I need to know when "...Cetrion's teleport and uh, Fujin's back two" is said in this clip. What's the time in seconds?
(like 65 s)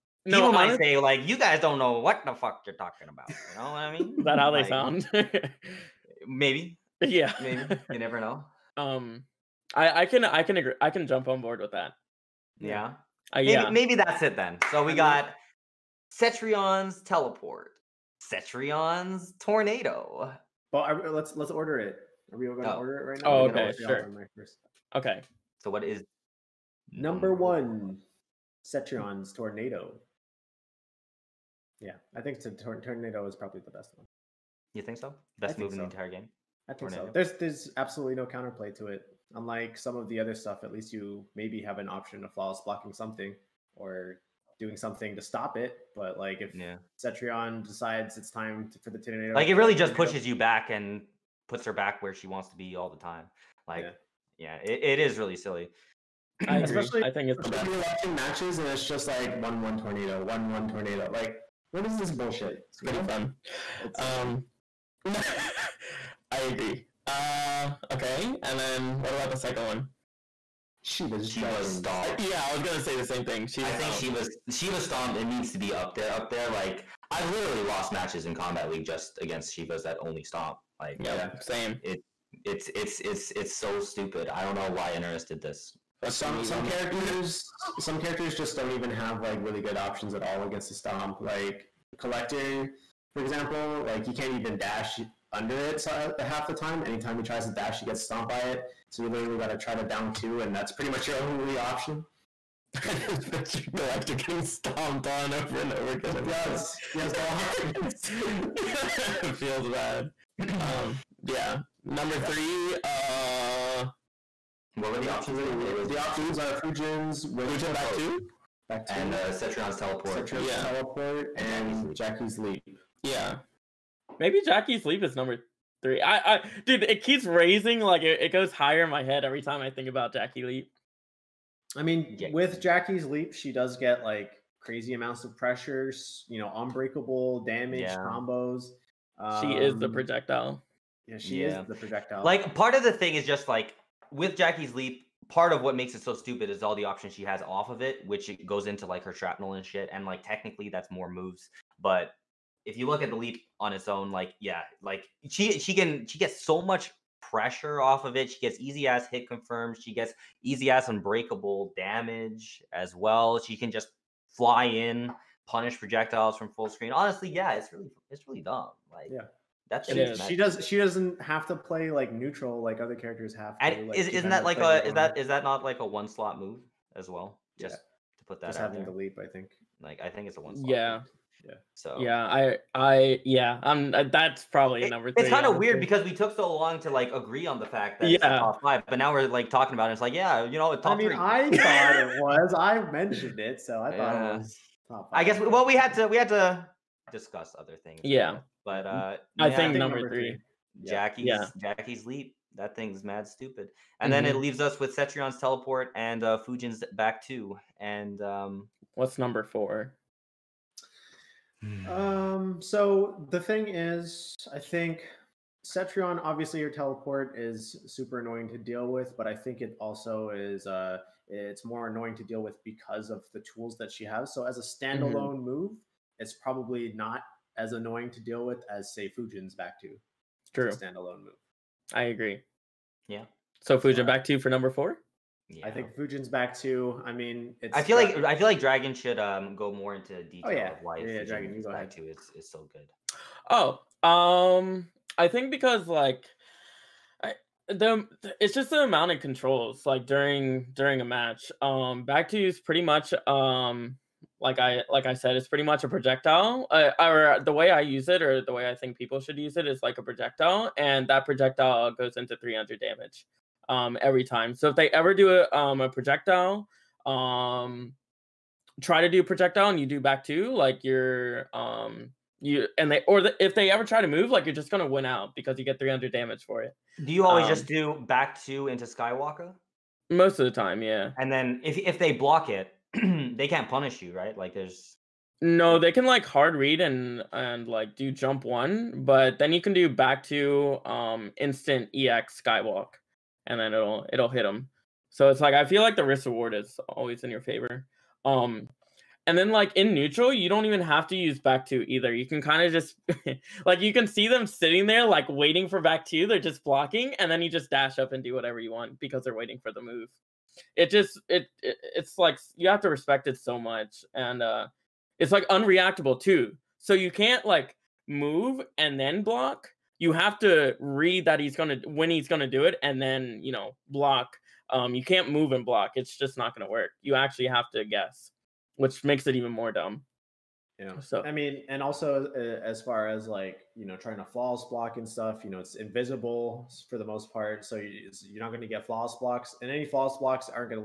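204 s.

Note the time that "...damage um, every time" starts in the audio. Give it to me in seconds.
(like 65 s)
262 s.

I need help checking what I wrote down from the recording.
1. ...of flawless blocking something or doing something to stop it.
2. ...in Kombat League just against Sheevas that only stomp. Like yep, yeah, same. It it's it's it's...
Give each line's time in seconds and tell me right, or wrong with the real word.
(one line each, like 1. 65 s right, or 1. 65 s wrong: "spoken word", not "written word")
1. 42 s right
2. 78 s right.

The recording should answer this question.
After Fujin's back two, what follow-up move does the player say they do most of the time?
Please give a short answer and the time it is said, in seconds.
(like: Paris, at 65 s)
Skywalk, at 278 s.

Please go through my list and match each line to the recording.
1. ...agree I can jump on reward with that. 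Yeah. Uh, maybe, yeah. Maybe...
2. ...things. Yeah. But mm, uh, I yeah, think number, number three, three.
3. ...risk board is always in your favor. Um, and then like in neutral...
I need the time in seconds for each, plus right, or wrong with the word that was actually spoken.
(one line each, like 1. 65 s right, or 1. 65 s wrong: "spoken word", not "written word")
1. 10 s wrong: "board", not "reward"
2. 197 s right
3. 296 s wrong: "reward", not "board".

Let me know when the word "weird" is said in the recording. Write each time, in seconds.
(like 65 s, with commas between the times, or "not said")
185 s.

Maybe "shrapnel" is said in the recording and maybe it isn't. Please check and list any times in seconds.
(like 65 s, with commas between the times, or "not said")
149 s.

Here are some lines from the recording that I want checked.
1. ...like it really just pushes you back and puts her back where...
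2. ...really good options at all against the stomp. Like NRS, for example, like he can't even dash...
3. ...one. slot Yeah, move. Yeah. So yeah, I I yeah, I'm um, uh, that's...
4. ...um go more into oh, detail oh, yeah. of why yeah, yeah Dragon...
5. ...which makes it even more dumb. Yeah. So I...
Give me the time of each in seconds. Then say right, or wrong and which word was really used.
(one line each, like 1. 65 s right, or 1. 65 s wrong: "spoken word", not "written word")
1. 49 s right
2. 89 s wrong: "Collector", not "NRS"
3. 180 s right
4. 239 s right
5. 328 s right.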